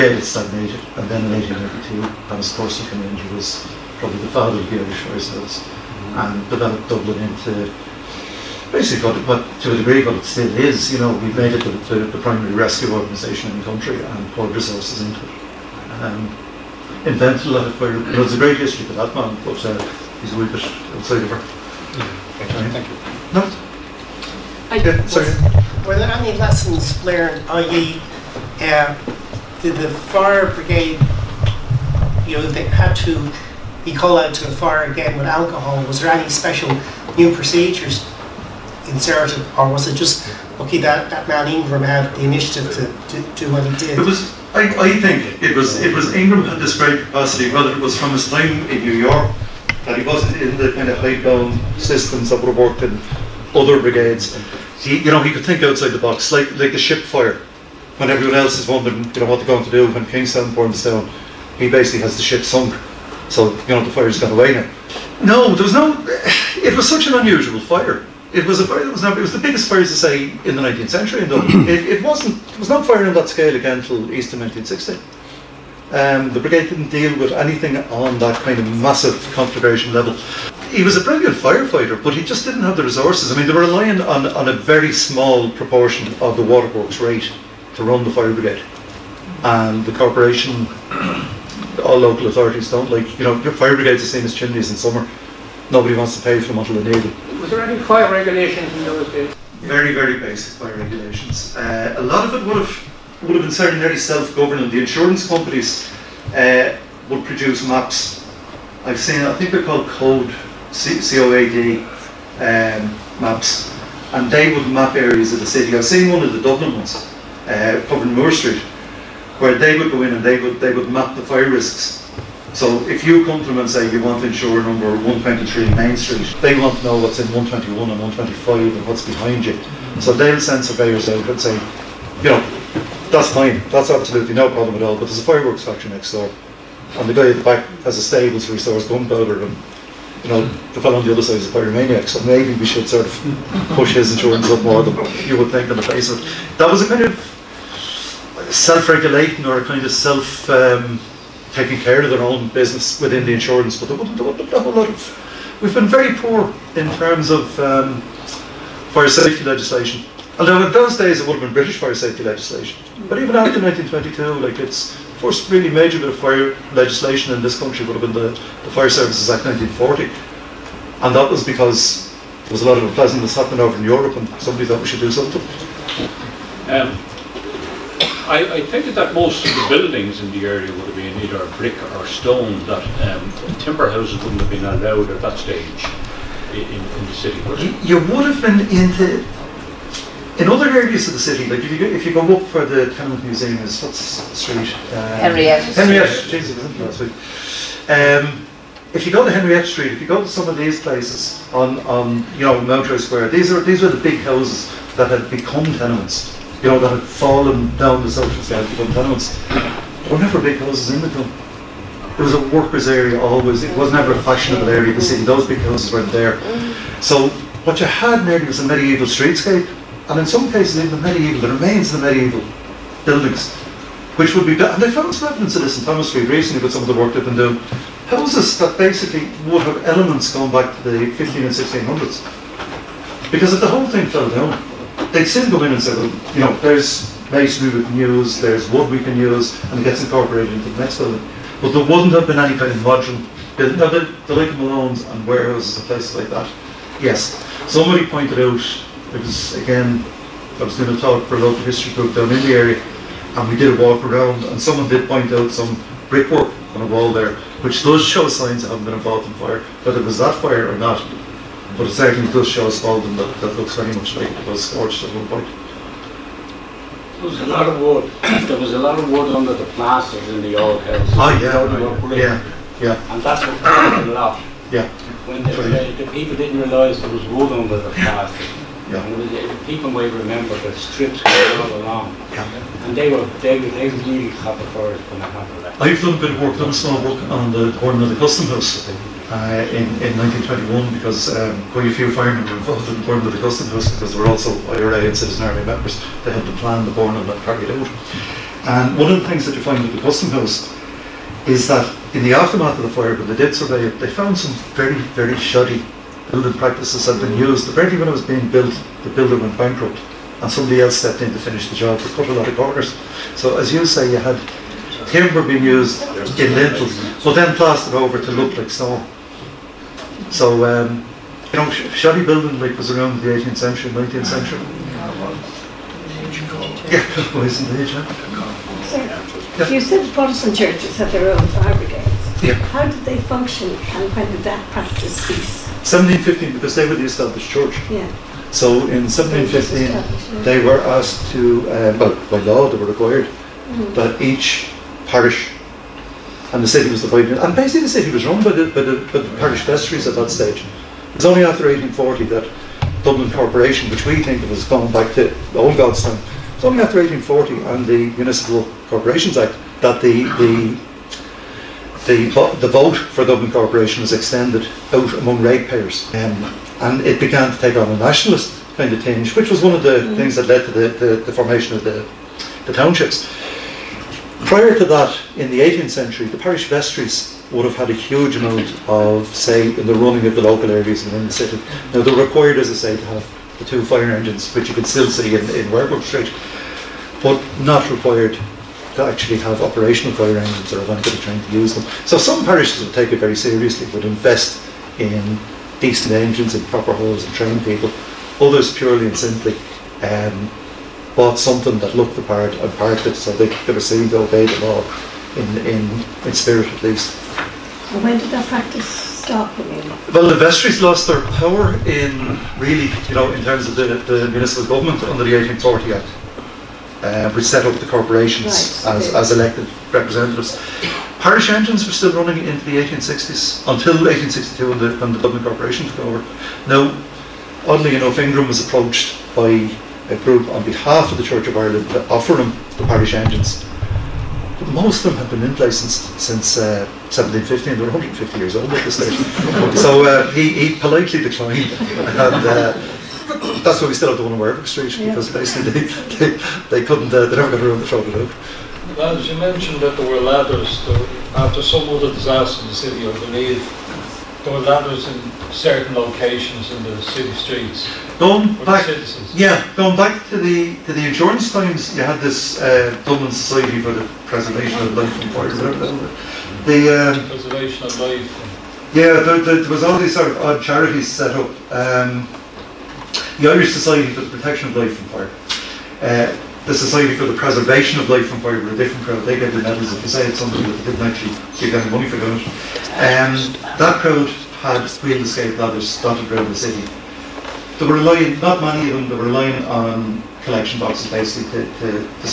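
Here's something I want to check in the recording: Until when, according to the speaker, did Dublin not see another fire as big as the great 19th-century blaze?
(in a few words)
Easter 1960.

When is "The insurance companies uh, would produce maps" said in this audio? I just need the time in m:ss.
1:44.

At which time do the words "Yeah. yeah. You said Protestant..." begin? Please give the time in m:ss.
5:27.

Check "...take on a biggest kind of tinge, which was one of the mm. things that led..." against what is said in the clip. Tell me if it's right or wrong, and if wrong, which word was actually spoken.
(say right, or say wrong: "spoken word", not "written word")
wrong: "nationalist", not "biggest".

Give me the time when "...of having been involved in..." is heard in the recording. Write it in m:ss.
4:18.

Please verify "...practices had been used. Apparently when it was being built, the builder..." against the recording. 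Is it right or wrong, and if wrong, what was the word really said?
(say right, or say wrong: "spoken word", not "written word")
right.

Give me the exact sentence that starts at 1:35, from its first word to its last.
Nobody wants to pay for them until they need them.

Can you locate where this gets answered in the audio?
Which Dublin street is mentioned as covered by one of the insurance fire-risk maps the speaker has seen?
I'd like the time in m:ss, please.
1:58.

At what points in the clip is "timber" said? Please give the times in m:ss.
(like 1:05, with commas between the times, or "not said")
3:03, 5:15.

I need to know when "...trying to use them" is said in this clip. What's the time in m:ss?
6:31.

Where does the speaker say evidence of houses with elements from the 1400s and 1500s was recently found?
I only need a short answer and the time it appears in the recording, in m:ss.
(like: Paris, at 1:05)
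Thomas Street, at 3:45.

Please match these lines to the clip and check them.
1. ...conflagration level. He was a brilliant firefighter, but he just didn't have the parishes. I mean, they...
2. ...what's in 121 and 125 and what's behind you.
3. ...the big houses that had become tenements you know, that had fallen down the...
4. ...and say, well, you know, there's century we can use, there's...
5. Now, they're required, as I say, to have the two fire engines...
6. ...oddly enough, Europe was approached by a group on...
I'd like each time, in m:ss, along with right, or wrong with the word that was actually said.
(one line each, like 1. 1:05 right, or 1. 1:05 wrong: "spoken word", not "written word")
1. 1:19 wrong: "resources", not "parishes"
2. 2:07 right
3. 3:23 right
4. 3:55 wrong: "masonry", not "century"
5. 6:21 right
6. 7:07 wrong: "Ingram", not "Europe".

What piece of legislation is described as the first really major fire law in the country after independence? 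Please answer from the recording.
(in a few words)
Fire Services Act 1940.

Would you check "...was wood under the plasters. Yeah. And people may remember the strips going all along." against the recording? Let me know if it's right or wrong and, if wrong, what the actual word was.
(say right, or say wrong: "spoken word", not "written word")
right.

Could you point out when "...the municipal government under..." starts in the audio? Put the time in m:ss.
6:54.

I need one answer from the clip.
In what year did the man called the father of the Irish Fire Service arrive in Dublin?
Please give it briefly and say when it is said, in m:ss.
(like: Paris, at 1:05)
1882, at 0:01.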